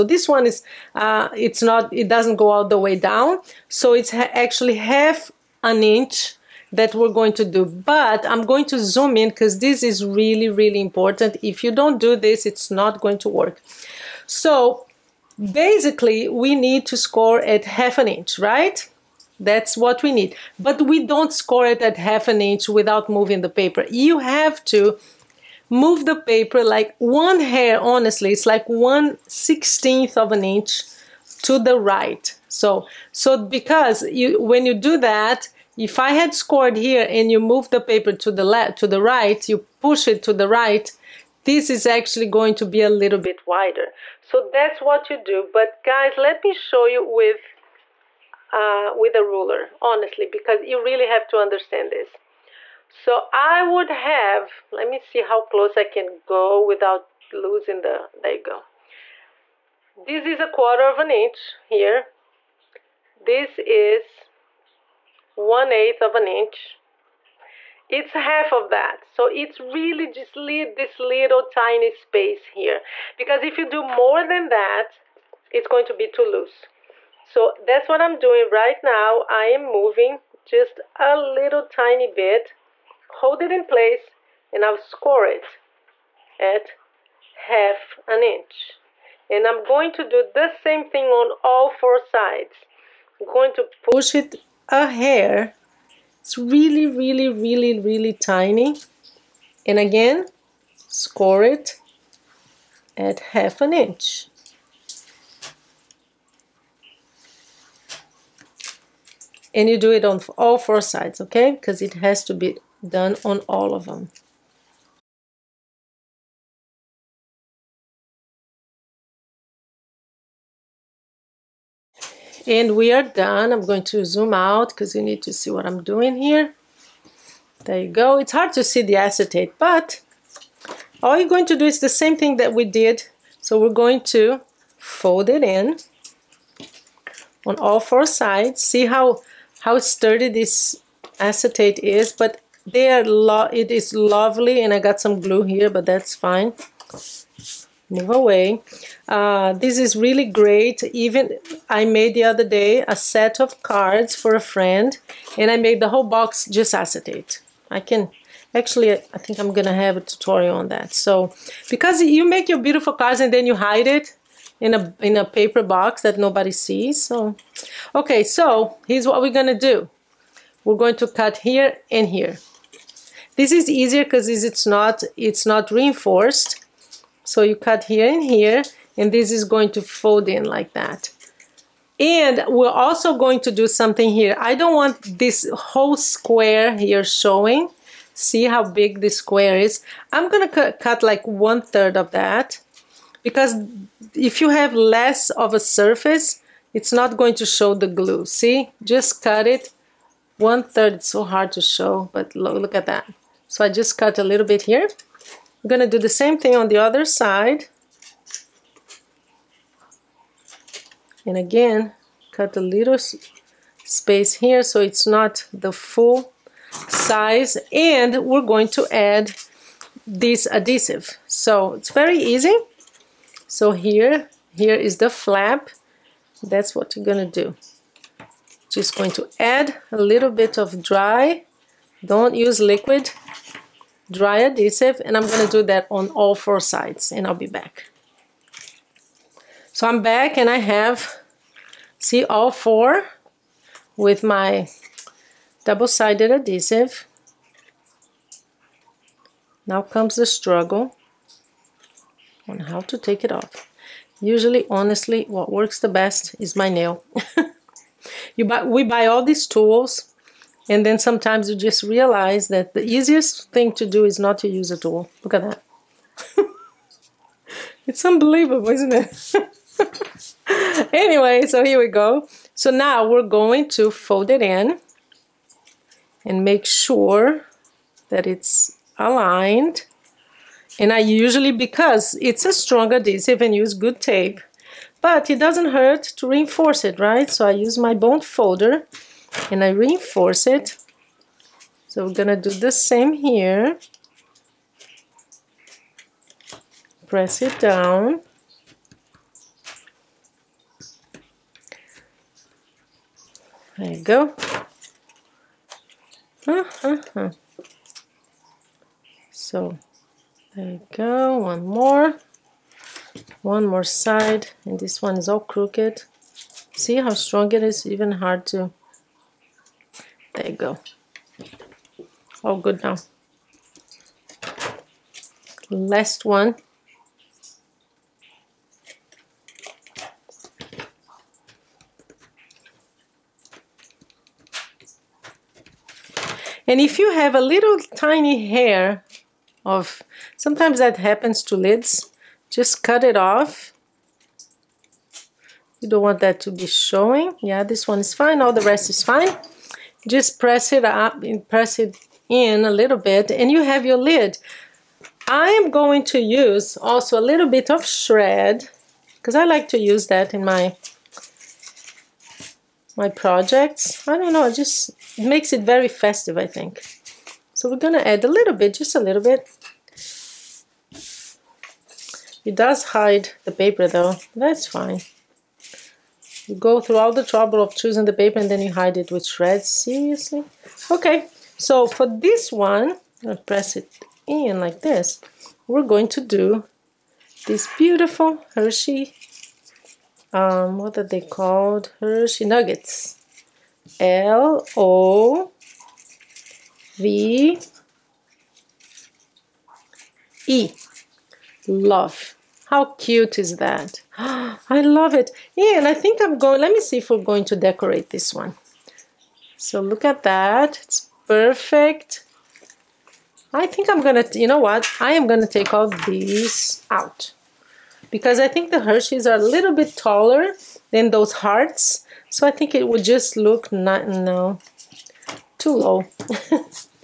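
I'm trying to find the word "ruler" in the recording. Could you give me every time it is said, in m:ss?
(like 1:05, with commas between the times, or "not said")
0:49.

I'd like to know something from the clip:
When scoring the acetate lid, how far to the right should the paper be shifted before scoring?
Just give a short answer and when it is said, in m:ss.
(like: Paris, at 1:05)
1/16 of an inch, at 0:28.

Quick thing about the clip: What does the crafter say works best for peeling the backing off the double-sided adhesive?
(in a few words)
my nail.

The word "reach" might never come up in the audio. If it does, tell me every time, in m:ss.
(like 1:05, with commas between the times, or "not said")
not said.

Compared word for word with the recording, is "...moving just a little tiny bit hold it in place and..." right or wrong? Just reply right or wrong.
right.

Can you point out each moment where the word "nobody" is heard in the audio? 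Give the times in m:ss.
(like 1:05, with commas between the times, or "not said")
2:46.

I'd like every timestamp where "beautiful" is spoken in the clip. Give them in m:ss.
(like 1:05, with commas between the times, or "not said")
2:42, 6:27.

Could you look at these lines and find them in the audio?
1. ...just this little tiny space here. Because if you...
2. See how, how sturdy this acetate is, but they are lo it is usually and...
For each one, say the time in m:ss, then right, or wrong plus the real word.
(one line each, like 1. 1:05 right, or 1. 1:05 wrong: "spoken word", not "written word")
1. 1:10 right
2. 2:18 wrong: "lovely", not "usually".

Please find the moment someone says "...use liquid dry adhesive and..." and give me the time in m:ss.
3:52.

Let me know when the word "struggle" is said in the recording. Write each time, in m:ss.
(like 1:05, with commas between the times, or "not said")
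4:10.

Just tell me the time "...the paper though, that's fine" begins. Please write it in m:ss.
6:13.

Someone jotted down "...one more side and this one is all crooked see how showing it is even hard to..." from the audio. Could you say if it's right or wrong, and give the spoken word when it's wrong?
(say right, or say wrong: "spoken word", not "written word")
wrong: "strong", not "showing".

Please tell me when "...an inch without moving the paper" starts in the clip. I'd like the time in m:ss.
0:22.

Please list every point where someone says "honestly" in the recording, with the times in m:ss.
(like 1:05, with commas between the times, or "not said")
0:27, 0:49, 4:14.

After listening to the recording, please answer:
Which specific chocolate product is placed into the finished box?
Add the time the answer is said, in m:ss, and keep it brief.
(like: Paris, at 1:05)
Hershey Nuggets, at 6:32.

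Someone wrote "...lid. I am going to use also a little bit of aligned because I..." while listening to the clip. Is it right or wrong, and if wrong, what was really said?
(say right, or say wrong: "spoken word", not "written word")
wrong: "shred", not "aligned".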